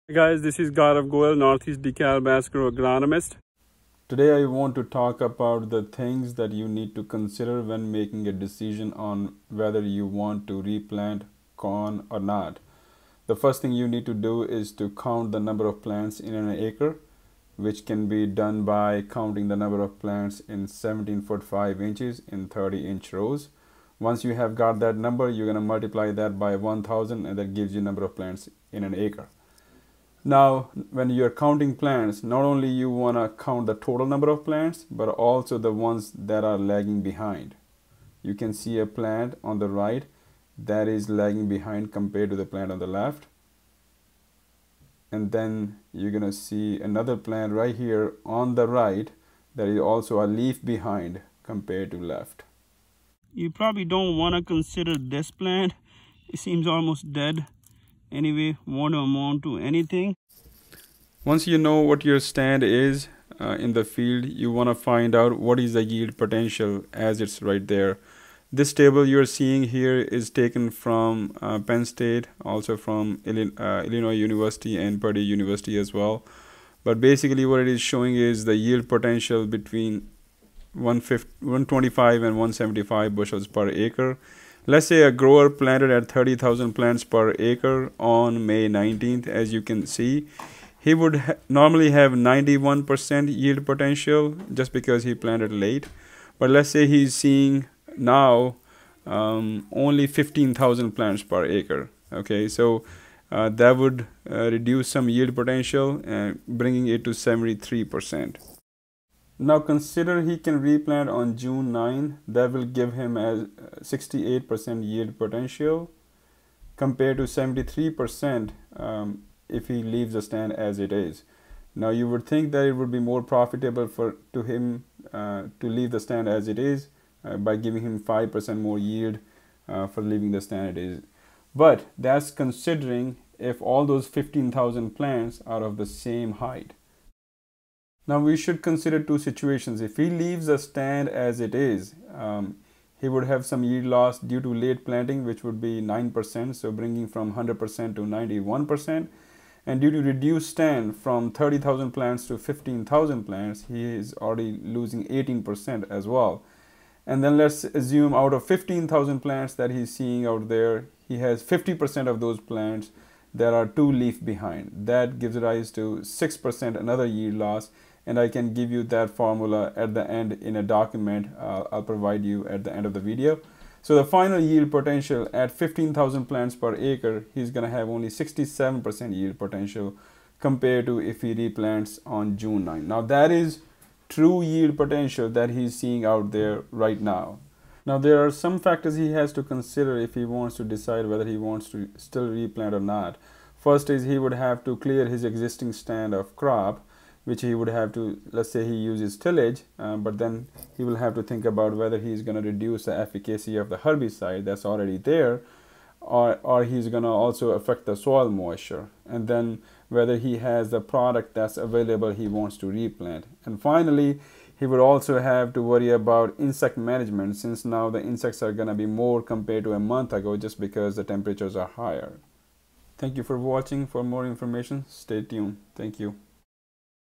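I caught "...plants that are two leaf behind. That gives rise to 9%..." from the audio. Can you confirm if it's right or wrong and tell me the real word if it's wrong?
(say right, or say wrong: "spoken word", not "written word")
wrong: "6", not "9".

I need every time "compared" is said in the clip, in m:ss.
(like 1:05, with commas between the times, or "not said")
0:41, 0:51, 1:56, 3:00, 3:39.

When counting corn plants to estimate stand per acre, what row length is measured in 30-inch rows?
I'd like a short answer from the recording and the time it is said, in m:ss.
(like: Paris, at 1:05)
17 feet 5 inches, at 0:20.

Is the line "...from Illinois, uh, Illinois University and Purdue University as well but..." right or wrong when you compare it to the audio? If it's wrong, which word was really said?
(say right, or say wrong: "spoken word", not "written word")
right.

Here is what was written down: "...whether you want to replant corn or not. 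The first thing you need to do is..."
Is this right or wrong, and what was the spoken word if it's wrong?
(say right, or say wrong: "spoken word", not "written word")
right.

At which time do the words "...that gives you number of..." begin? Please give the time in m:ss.
0:27.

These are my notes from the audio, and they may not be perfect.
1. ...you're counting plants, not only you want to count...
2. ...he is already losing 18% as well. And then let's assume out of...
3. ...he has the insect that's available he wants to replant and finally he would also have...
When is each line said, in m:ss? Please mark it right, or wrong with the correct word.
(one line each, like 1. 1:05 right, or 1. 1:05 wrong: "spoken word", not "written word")
1. 0:31 right
2. 2:33 right
3. 3:30 wrong: "product", not "insect".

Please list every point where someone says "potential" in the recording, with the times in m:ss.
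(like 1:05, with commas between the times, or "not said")
1:06, 1:18, 1:33, 1:45, 1:55, 2:54, 2:59, 3:04.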